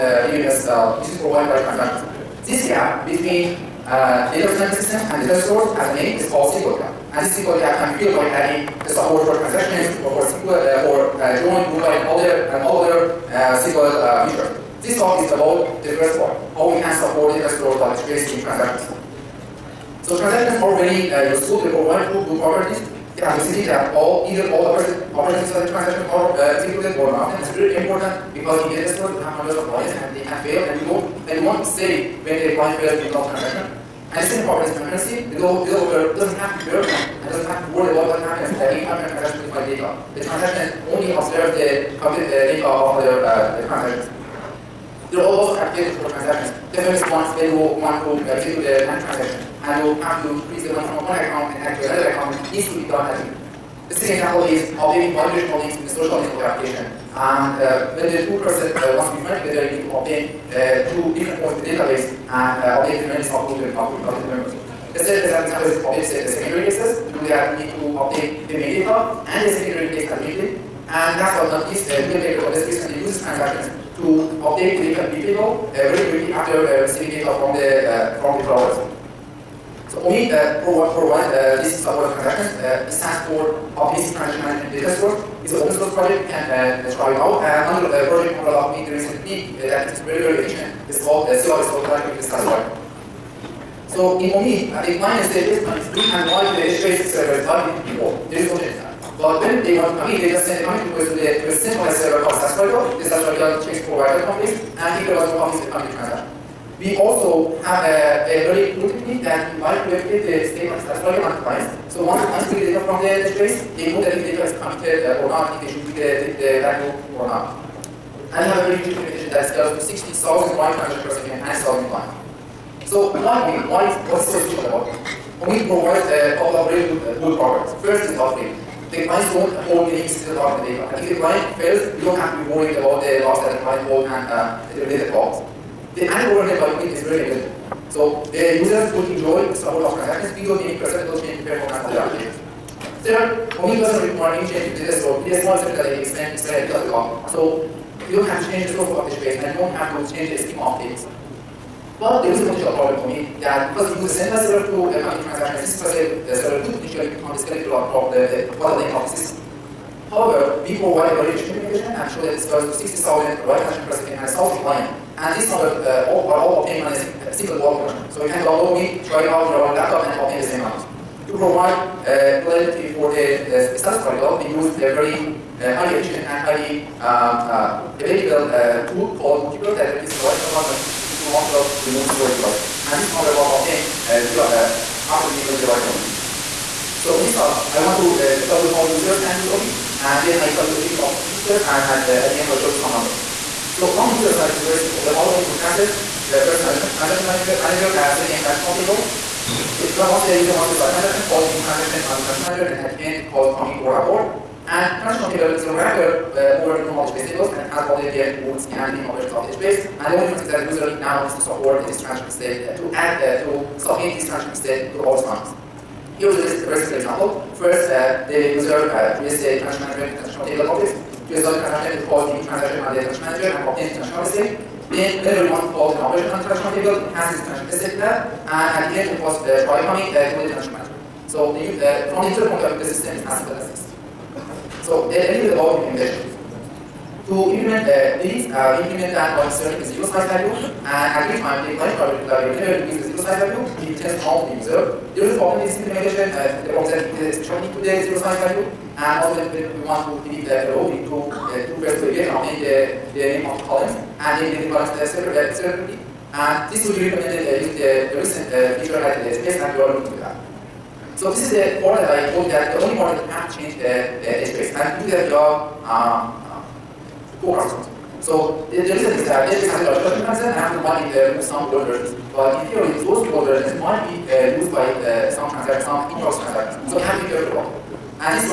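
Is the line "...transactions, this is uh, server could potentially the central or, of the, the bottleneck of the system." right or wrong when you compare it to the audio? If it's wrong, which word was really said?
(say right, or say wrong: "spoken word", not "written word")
wrong: "skeletal", not "central".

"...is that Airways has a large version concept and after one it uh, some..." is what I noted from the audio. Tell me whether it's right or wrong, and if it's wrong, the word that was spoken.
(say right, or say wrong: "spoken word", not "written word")
right.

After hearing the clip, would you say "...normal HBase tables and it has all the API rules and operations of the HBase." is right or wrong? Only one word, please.
right.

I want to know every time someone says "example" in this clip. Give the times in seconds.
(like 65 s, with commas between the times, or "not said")
54 s, 216 s.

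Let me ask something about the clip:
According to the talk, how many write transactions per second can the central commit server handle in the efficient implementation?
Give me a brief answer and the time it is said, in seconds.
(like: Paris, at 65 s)
60,000, at 162 s.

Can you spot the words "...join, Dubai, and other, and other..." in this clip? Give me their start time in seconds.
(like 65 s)
11 s.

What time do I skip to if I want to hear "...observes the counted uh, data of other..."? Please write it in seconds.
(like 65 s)
41 s.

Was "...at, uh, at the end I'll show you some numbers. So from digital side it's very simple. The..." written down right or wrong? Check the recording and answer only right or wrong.
right.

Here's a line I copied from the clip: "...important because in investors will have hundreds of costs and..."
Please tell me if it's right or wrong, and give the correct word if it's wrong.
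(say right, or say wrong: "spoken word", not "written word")
wrong: "clients", not "costs".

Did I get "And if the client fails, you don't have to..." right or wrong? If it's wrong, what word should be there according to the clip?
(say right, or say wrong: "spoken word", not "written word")
right.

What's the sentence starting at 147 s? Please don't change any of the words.
So you don't have to change the source of the space, and you don't have to change the scheme of things.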